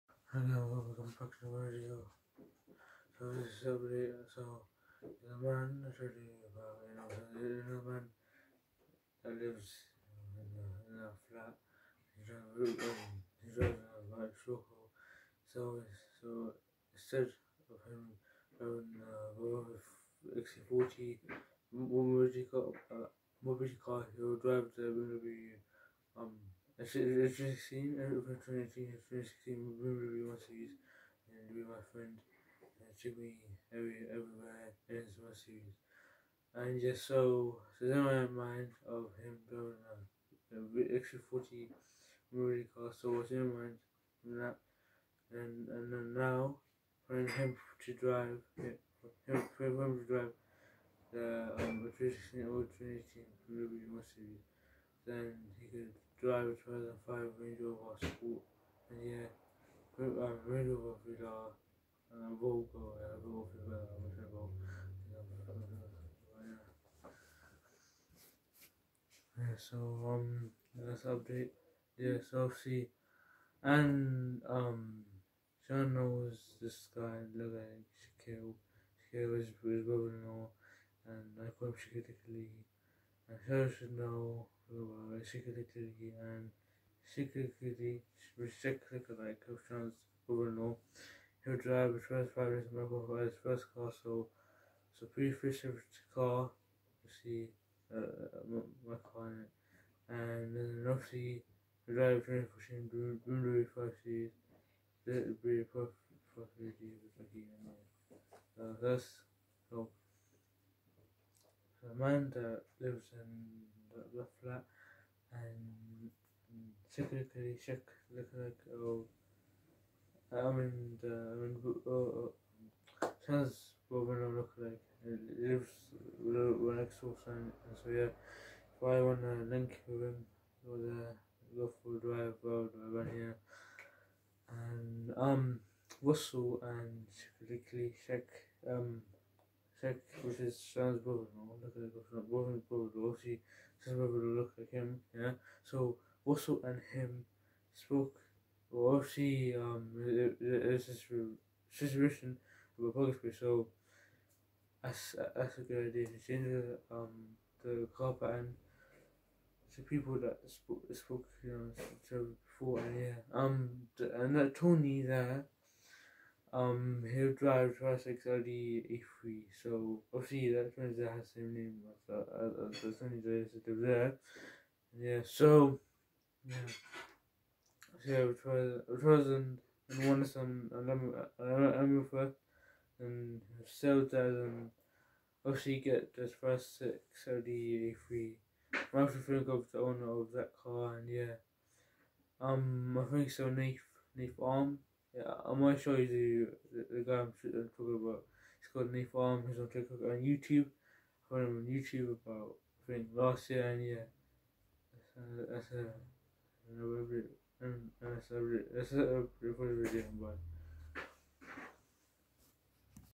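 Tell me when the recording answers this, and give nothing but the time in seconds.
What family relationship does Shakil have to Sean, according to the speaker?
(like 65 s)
79 s.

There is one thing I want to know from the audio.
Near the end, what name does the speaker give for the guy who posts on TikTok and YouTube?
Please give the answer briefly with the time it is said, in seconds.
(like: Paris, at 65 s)
Nate Farm, at 198 s.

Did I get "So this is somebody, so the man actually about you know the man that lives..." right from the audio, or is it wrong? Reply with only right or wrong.
right.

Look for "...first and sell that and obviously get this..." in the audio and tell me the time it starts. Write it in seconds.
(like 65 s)
182 s.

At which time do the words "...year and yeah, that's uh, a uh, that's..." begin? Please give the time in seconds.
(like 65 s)
203 s.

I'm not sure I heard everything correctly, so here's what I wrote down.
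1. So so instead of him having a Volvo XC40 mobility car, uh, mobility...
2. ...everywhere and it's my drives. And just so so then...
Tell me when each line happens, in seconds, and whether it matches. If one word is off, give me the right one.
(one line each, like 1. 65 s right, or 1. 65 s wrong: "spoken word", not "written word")
1. 15 s right
2. 34 s wrong: "series", not "drives".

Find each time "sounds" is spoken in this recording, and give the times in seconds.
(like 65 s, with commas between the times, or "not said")
123 s, 140 s.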